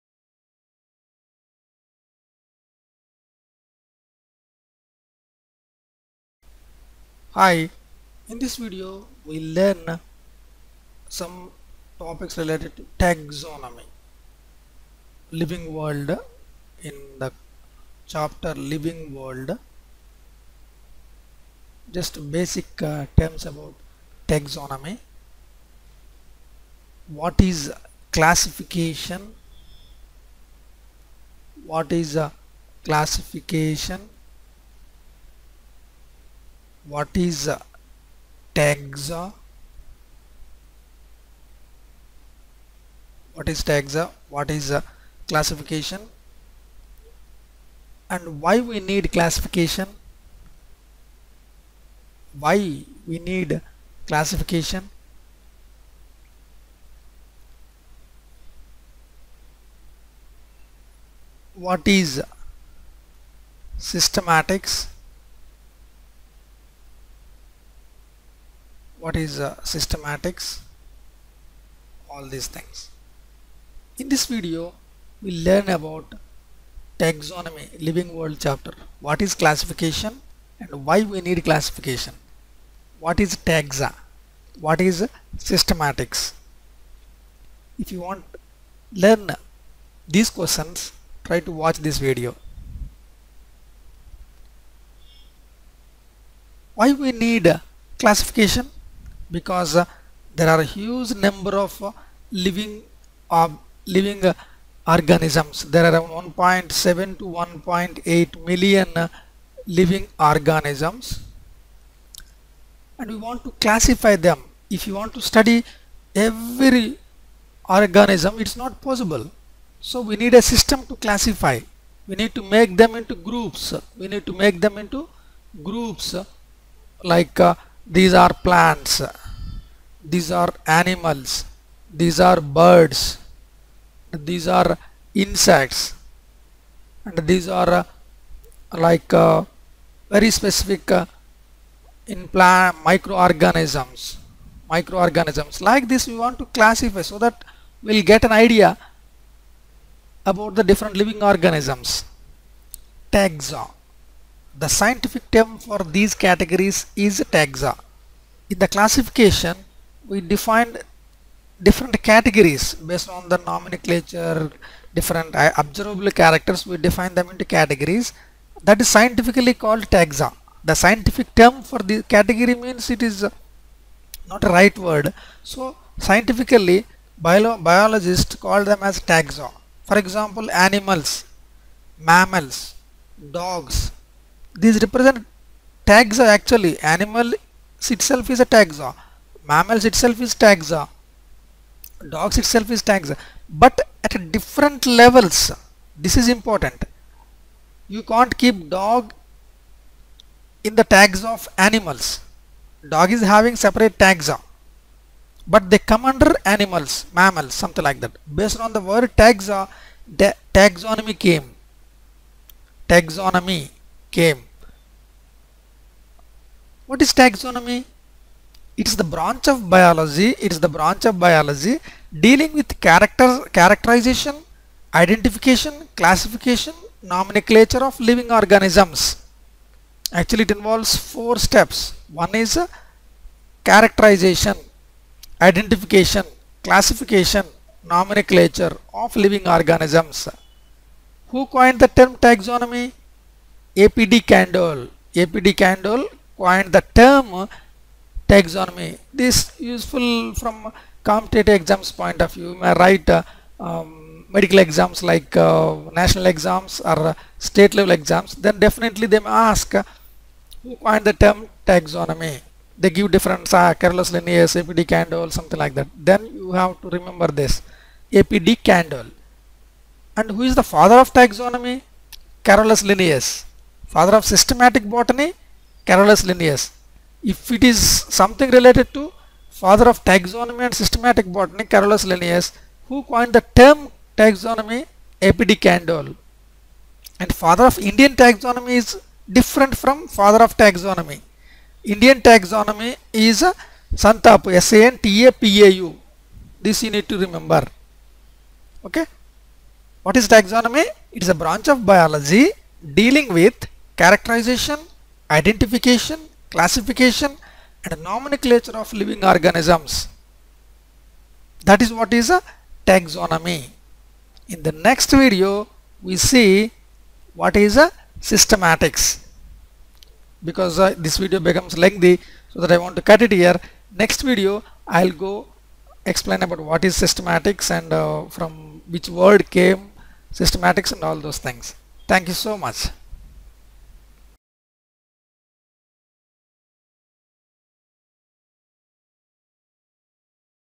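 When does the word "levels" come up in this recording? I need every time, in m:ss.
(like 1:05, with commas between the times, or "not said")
3:15, 4:17.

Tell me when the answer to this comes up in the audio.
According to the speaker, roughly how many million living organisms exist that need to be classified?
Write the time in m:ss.
1:46.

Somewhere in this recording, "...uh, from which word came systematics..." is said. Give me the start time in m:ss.
5:27.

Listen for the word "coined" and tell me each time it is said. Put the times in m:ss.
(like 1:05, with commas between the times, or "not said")
4:01, 4:06, 4:20, 4:43.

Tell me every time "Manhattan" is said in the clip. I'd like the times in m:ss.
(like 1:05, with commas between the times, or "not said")
not said.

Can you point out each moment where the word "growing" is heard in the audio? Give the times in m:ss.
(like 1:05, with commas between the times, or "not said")
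not said.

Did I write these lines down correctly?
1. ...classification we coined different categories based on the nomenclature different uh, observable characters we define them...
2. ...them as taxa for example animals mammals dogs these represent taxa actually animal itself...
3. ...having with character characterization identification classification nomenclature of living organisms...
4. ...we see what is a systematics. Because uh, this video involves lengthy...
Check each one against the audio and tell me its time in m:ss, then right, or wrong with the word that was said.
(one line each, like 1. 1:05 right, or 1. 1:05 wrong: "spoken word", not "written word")
1. 2:38 wrong: "defined", not "coined"
2. 2:58 right
3. 3:42 wrong: "dealing", not "having"
4. 5:16 wrong: "becomes", not "involves".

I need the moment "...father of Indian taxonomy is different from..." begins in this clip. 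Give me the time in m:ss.
4:47.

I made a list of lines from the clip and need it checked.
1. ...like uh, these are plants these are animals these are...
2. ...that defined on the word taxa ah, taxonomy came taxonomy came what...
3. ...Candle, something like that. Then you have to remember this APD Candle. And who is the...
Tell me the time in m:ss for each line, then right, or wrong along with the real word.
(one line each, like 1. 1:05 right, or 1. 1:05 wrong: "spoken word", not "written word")
1. 2:07 right
2. 3:28 wrong: "based", not "defined"
3. 4:24 right.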